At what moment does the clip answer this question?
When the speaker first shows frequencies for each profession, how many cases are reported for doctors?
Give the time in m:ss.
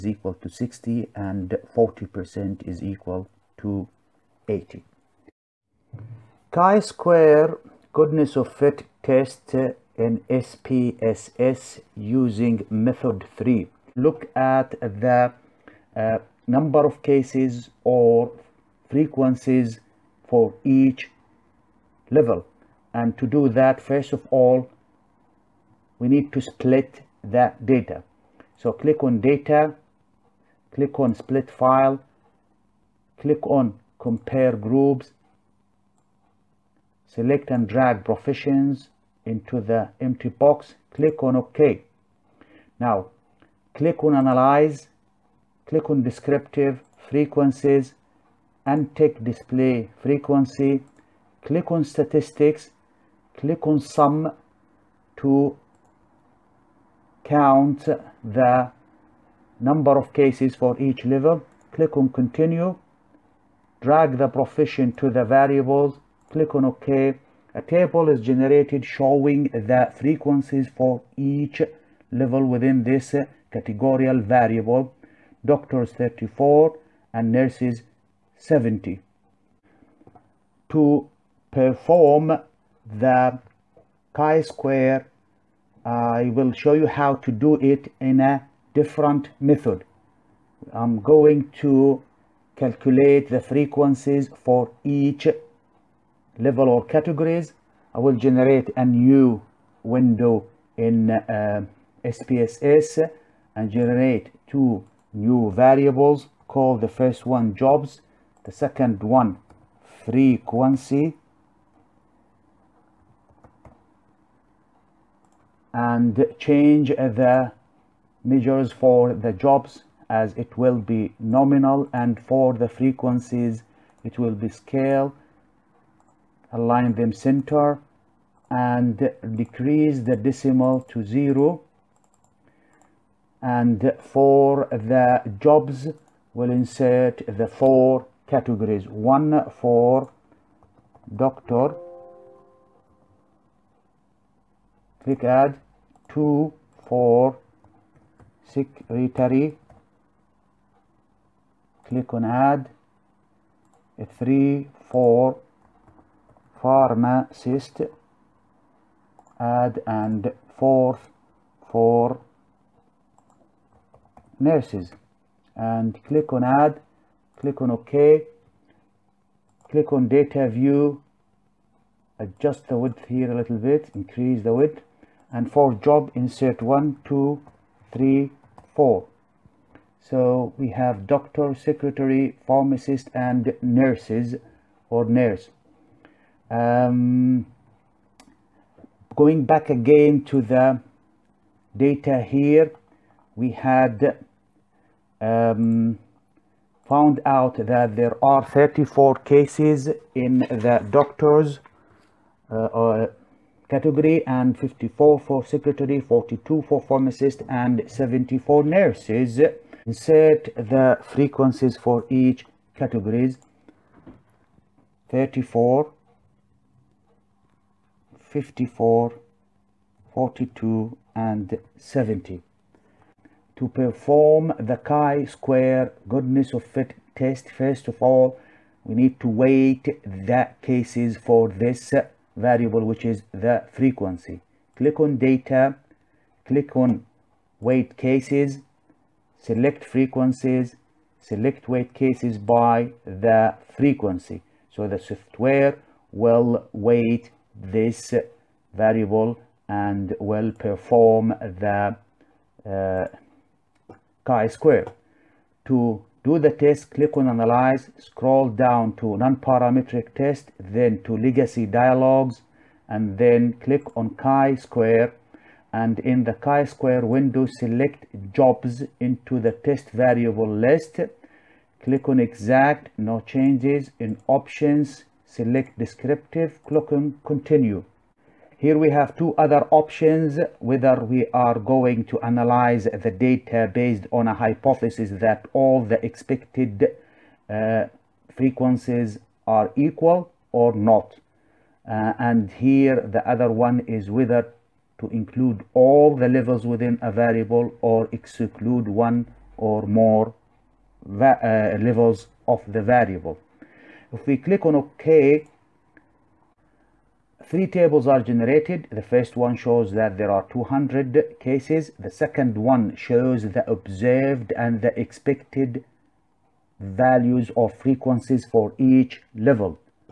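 1:15.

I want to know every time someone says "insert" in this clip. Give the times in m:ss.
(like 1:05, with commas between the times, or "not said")
2:16, 2:56, 3:29.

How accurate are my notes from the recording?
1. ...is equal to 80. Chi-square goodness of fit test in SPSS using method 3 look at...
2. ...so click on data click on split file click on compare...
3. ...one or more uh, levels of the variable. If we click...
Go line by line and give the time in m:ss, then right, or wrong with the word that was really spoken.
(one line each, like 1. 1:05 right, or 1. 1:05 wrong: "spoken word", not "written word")
1. 0:02 right
2. 0:28 right
3. 4:58 right.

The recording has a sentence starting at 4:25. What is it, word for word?
And in the chi-square window, select Jobs into the test variable list.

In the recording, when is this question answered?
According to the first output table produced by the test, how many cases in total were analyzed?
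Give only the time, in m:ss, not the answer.
5:10.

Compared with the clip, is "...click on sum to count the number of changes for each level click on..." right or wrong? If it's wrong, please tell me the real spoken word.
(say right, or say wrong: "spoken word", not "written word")
wrong: "cases", not "changes".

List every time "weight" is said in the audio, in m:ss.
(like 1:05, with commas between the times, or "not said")
3:49, 3:57, 4:01, 4:06.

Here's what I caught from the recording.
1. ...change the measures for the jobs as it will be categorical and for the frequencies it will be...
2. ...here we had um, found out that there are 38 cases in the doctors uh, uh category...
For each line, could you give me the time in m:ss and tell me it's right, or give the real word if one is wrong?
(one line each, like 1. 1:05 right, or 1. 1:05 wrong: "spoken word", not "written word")
1. 1:56 wrong: "nominal", not "categorical"
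2. 3:12 wrong: "34", not "38".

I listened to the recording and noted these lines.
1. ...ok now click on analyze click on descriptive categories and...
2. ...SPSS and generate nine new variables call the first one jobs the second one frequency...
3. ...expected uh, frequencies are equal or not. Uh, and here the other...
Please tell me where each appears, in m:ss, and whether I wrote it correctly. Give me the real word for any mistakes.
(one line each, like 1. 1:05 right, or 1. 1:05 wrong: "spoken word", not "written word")
1. 0:41 wrong: "frequencies", not "categories"
2. 1:42 wrong: "two", not "nine"
3. 4:46 right.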